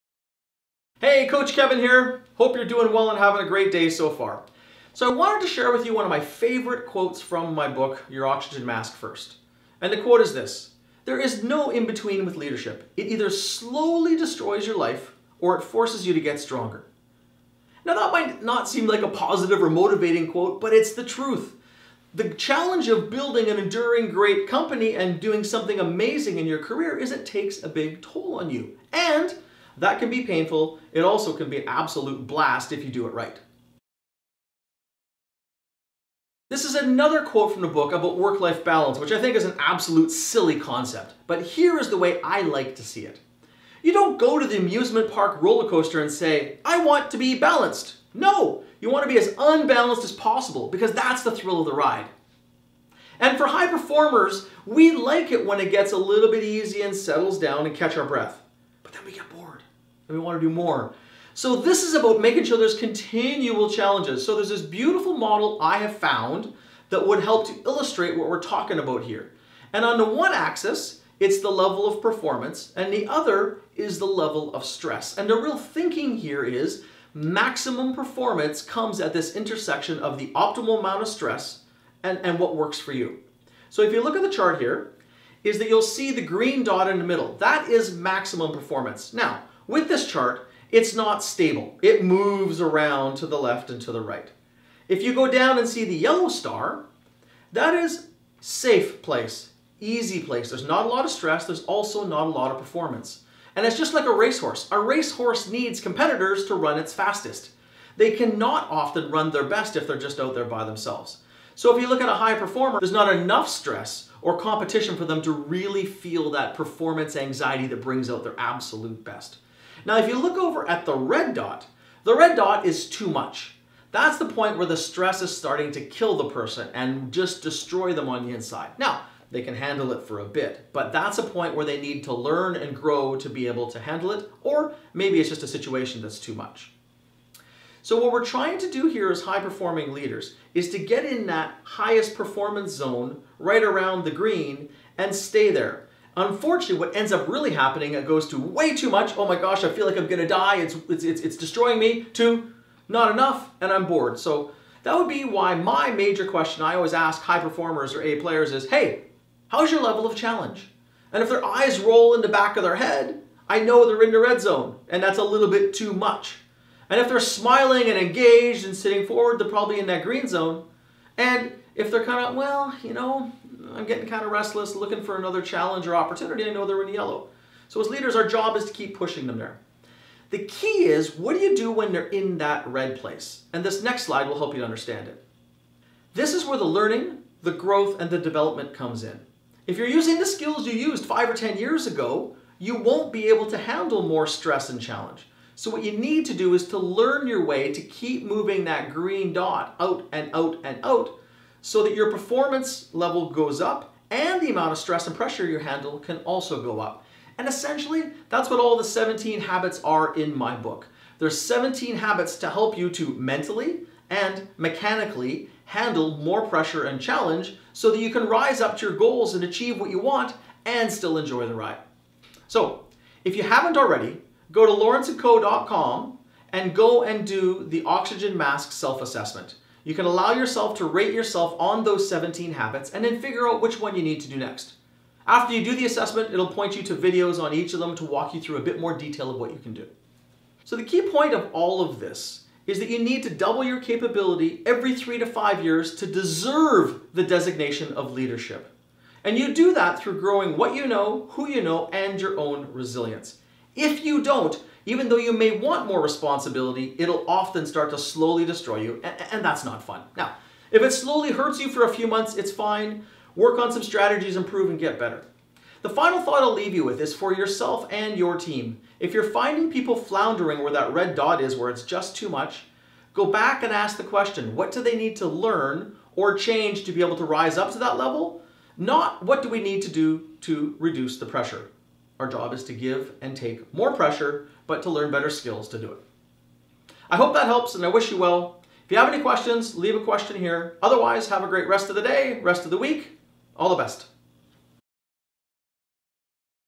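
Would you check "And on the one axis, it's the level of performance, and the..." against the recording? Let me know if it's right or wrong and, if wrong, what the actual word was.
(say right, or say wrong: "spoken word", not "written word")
right.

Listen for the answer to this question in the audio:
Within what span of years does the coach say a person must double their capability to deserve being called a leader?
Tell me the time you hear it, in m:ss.
4:04.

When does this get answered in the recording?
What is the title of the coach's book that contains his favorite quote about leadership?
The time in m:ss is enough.
0:08.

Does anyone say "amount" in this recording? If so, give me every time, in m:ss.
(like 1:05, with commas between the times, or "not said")
1:20, 3:24.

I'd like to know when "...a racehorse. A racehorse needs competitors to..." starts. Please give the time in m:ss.
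1:44.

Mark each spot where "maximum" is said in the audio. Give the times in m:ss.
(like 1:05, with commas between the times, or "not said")
1:17, 1:27.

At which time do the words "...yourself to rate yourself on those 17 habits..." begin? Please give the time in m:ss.
3:50.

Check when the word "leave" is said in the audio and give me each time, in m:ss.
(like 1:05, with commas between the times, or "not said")
4:26, 4:49.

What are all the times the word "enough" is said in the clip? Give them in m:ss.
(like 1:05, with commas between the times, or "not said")
1:53, 2:33.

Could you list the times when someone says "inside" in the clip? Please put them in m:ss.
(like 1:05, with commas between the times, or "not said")
2:08.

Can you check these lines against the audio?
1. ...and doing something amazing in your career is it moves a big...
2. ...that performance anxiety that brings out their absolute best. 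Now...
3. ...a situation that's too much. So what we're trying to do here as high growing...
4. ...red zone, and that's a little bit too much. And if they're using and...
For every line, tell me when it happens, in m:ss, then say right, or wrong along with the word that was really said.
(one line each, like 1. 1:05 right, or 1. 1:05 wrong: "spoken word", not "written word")
1. 0:24 wrong: "takes", not "moves"
2. 1:56 right
3. 2:15 wrong: "performing", not "growing"
4. 2:44 wrong: "smiling", not "using".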